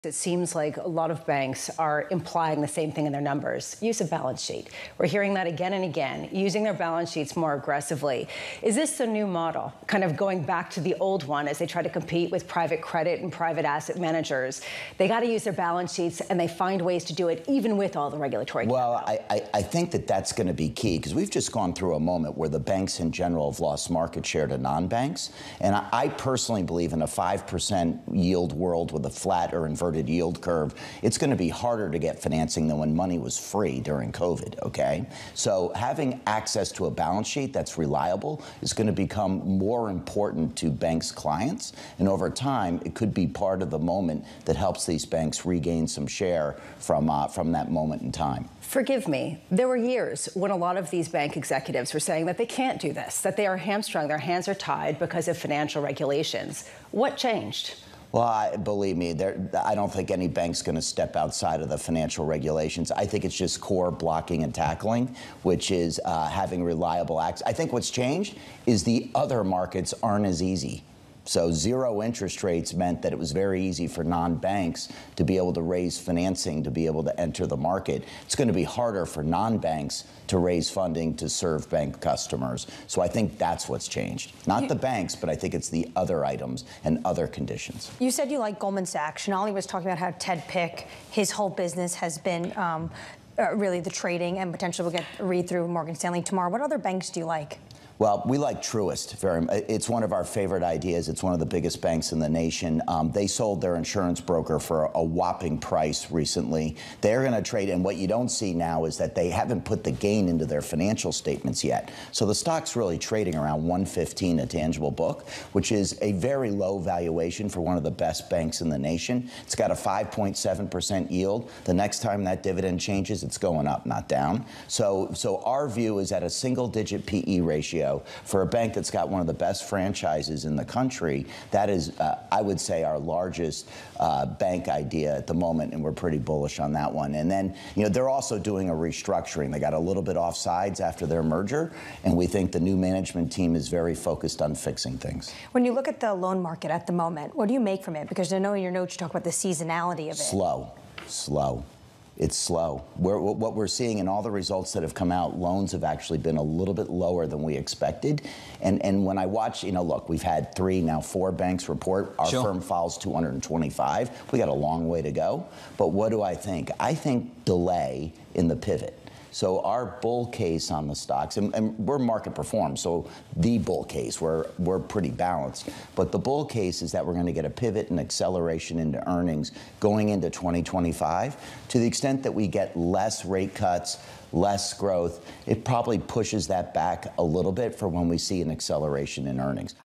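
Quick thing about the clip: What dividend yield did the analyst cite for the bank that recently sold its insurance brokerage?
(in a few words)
5.7%.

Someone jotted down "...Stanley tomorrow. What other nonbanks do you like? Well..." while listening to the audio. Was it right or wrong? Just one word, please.
wrong.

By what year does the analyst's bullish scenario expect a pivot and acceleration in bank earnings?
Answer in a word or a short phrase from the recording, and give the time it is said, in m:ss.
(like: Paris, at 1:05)
2025, at 3:00.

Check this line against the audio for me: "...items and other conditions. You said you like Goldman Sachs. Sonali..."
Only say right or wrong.
right.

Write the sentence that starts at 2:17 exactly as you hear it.
And then, you know, they're also doing a restructuring.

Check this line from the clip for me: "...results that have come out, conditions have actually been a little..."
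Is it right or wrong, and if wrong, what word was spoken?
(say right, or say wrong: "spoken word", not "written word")
wrong: "loans", not "conditions".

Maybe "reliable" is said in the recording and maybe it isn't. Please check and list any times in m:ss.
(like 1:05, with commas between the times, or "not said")
0:37, 1:06.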